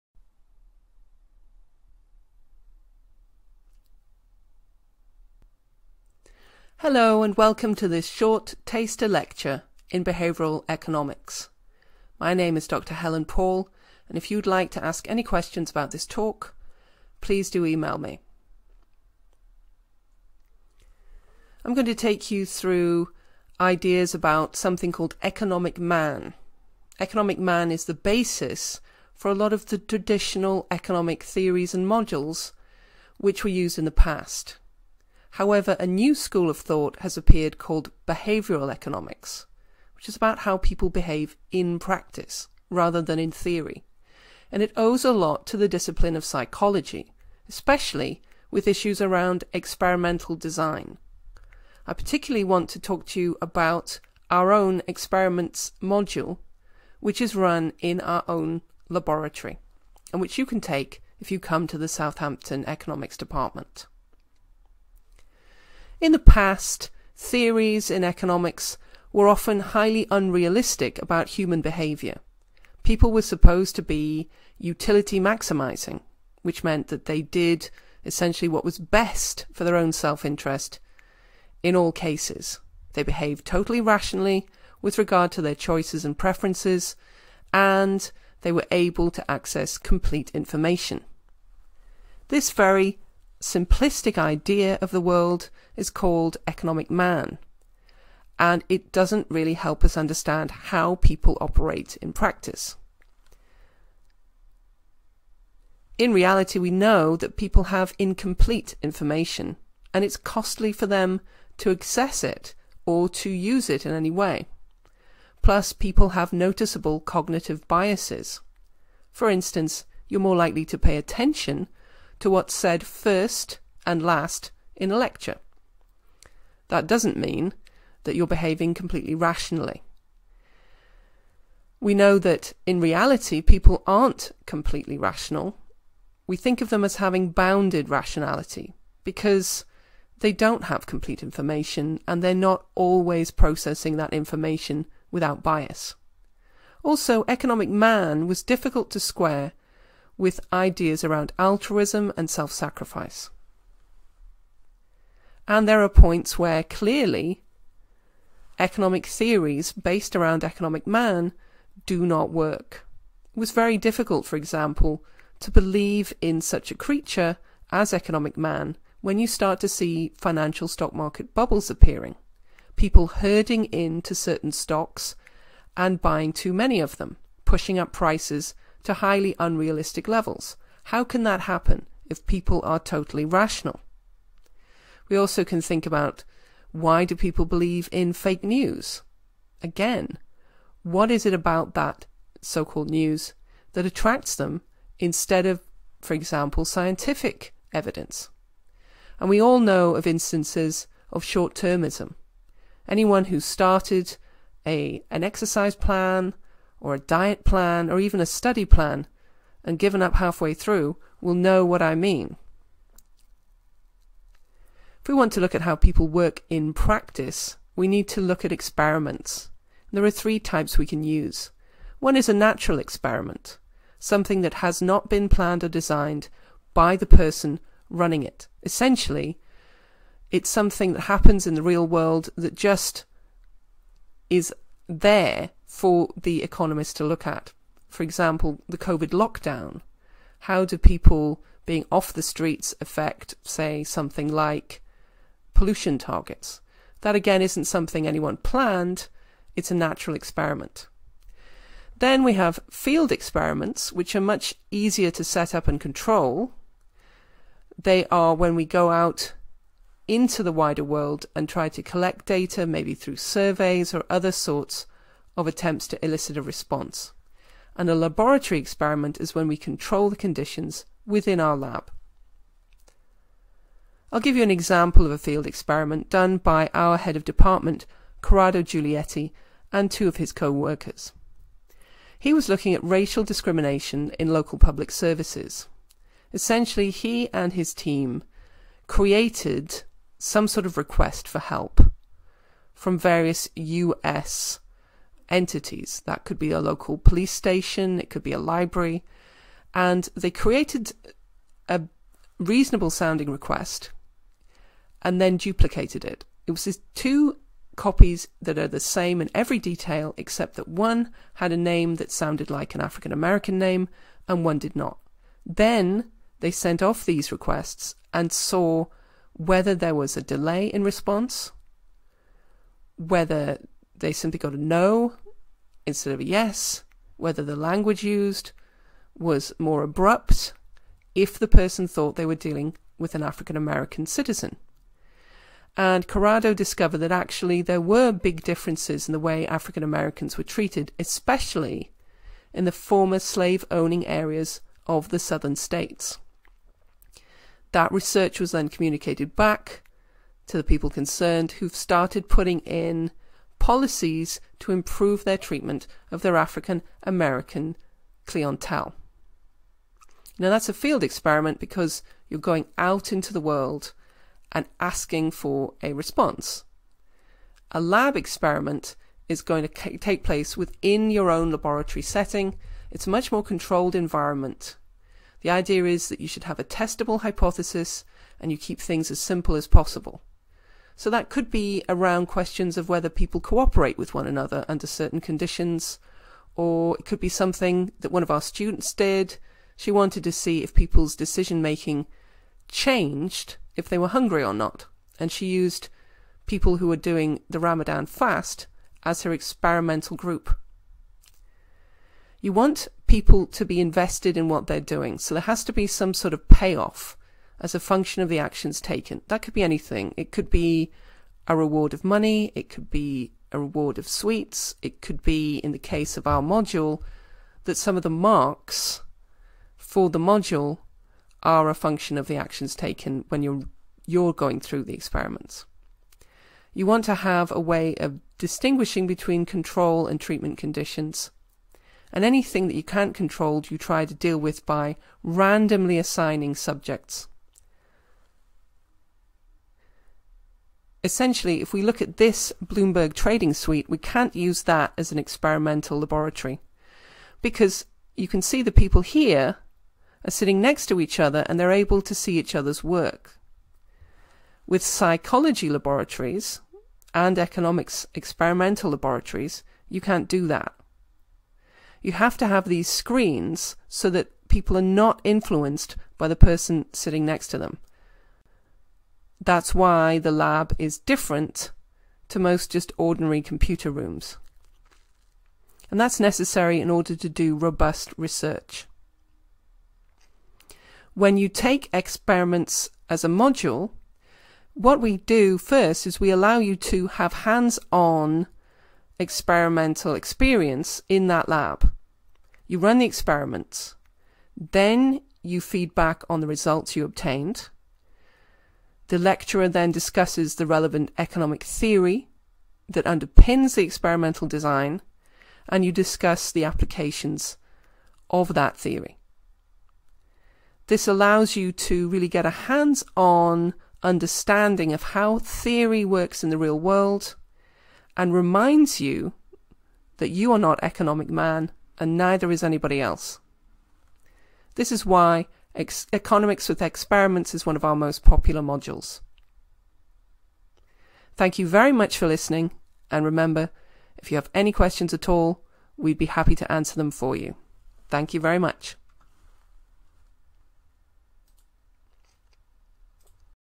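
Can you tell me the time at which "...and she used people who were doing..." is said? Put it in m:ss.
6:35.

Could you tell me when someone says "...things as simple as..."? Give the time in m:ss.
6:18.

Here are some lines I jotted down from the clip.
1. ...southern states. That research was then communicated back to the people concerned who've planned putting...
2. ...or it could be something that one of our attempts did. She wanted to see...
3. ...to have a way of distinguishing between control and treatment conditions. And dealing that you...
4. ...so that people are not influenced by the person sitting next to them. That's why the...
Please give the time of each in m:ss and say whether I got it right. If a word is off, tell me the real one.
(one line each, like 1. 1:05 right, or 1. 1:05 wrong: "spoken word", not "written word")
1. 5:45 wrong: "started", not "planned"
2. 6:26 wrong: "students", not "attempts"
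3. 7:07 wrong: "anything", not "dealing"
4. 7:43 right.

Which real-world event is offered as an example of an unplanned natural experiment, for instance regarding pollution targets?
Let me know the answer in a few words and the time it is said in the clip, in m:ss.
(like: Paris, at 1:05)
The COVID lockdown, at 3:58.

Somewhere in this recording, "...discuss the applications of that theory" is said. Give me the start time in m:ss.
8:25.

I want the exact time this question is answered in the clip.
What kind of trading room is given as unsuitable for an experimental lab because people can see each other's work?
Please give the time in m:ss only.
7:22.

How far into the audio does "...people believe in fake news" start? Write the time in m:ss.
3:07.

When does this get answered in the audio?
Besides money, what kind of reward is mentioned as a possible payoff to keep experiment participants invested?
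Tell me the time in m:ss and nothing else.
6:54.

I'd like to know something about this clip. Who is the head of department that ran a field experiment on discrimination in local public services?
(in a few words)
Corrado Giulietti.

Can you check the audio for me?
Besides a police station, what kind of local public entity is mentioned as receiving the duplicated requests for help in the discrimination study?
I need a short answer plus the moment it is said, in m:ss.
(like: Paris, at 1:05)
A library, at 4:58.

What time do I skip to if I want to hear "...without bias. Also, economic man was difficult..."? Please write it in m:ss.
2:25.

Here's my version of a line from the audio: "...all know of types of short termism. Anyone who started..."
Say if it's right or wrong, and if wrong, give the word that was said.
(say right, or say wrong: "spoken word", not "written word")
wrong: "instances", not "types".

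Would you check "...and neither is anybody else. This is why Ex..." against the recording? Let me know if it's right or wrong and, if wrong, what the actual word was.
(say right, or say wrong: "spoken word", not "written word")
right.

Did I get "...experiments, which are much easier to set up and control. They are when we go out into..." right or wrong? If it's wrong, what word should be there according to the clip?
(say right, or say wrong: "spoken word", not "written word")
right.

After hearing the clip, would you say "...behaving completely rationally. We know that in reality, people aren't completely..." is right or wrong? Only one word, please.
right.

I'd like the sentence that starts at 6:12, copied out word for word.
It's a much more controlled environment.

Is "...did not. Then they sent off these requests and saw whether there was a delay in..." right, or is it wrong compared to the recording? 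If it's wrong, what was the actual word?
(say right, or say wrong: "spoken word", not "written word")
right.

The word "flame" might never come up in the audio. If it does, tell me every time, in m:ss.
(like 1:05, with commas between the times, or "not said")
not said.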